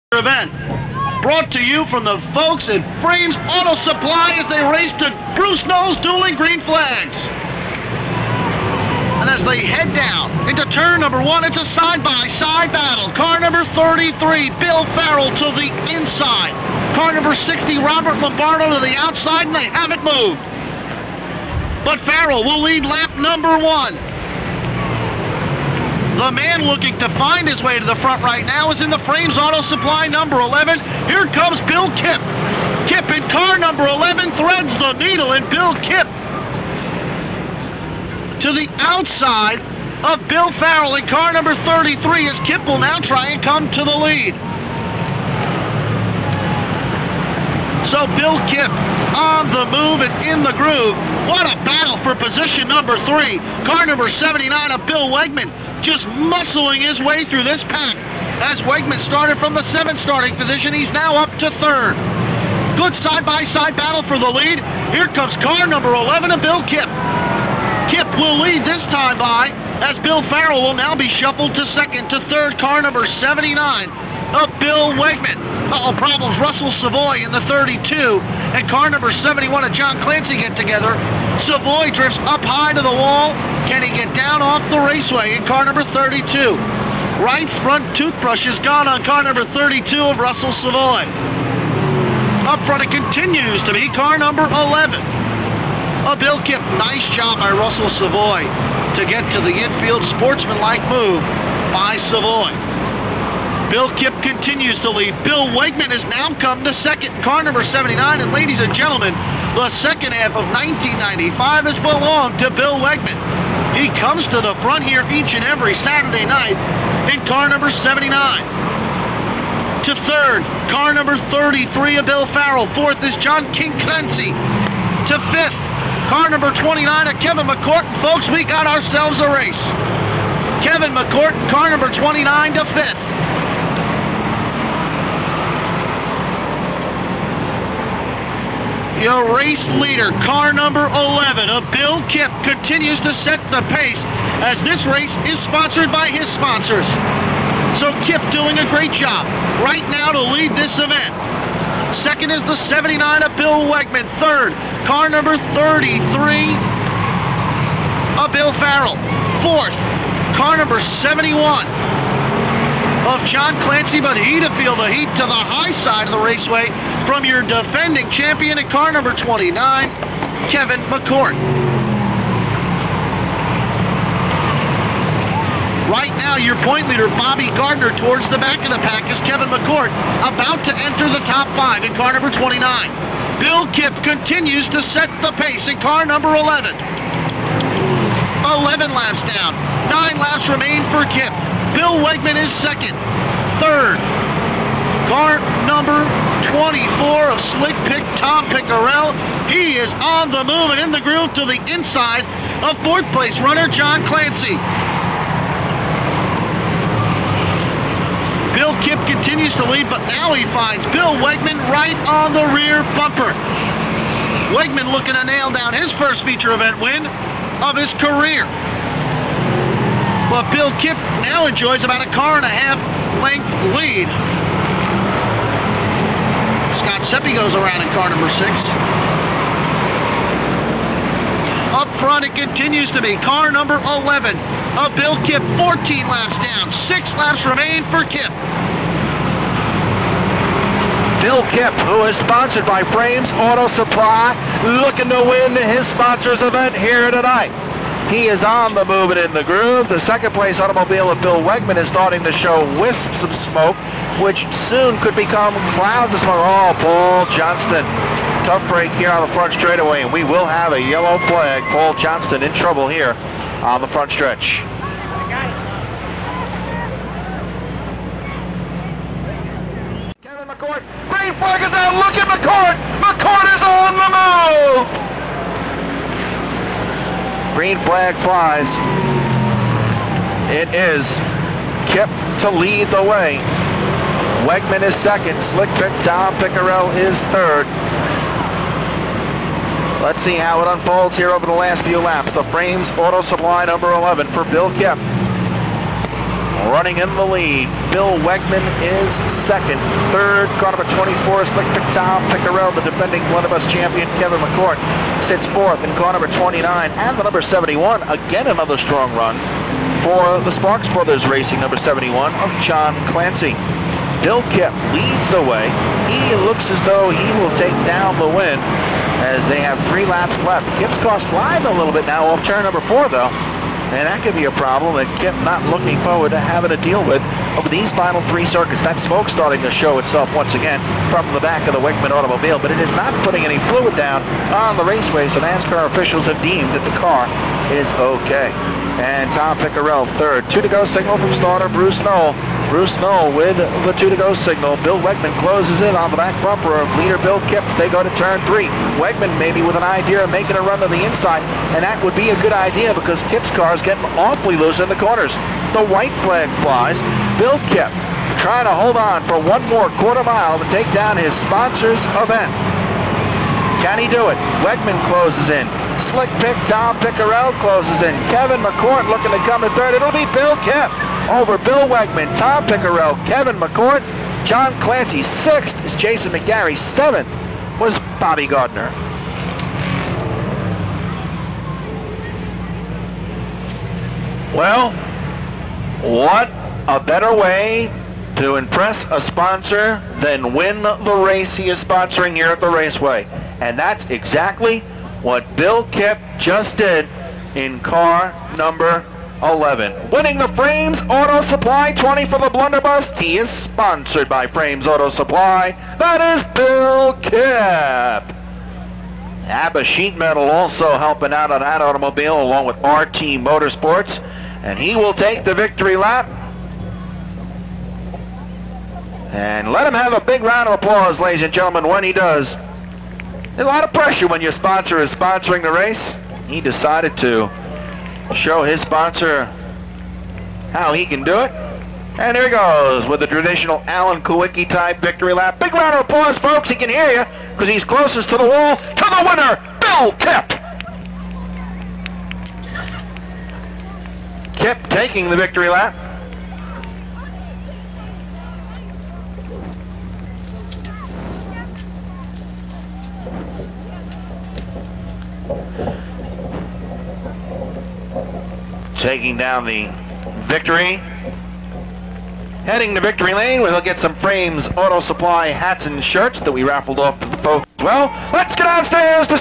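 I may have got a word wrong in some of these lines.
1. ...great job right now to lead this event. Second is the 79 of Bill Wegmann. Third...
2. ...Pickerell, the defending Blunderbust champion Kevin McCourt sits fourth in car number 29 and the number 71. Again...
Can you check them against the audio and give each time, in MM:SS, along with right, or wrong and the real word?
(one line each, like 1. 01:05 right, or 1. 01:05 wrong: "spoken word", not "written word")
1. 02:28 right
2. 05:02 right.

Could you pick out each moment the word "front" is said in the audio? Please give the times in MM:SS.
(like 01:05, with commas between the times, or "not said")
00:27, 01:27, 01:32, 01:54, 03:51, 04:19, 04:23.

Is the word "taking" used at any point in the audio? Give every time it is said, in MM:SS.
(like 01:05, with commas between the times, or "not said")
07:24, 07:39.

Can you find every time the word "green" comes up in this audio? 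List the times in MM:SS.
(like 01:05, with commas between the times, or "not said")
00:06, 04:31, 04:37.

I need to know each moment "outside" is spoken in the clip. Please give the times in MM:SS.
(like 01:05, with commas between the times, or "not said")
00:18, 00:38.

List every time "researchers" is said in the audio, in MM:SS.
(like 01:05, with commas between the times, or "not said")
not said.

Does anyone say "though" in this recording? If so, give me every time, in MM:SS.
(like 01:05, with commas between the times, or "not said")
05:16, 05:23.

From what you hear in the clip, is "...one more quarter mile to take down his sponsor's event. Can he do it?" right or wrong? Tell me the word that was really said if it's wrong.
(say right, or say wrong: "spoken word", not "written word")
right.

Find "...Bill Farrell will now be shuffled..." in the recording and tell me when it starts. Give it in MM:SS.
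01:09.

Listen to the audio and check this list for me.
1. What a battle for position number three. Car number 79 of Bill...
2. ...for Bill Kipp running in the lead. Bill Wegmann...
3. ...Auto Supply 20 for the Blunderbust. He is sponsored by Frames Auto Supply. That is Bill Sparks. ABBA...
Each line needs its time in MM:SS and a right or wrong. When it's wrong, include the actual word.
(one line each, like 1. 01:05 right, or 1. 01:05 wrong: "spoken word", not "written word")
1. 00:51 right
2. 04:54 right
3. 06:41 wrong: "Kipp", not "Sparks".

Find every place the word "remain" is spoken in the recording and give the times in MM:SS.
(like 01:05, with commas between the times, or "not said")
03:10, 03:57.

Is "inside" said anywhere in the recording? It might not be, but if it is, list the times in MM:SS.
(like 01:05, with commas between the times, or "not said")
00:15, 03:21, 05:51.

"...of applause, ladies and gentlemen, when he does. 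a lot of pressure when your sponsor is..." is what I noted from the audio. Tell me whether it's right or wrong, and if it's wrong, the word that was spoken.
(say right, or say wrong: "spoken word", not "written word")
right.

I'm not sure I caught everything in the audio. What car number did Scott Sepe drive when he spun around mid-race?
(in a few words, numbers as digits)
6.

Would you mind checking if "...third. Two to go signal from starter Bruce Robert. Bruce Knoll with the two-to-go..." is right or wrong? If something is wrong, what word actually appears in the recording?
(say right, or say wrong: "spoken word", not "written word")
wrong: "Knoll", not "Robert".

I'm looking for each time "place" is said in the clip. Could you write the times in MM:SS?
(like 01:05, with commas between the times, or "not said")
03:23, 04:10.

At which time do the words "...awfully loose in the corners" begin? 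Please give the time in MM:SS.
05:54.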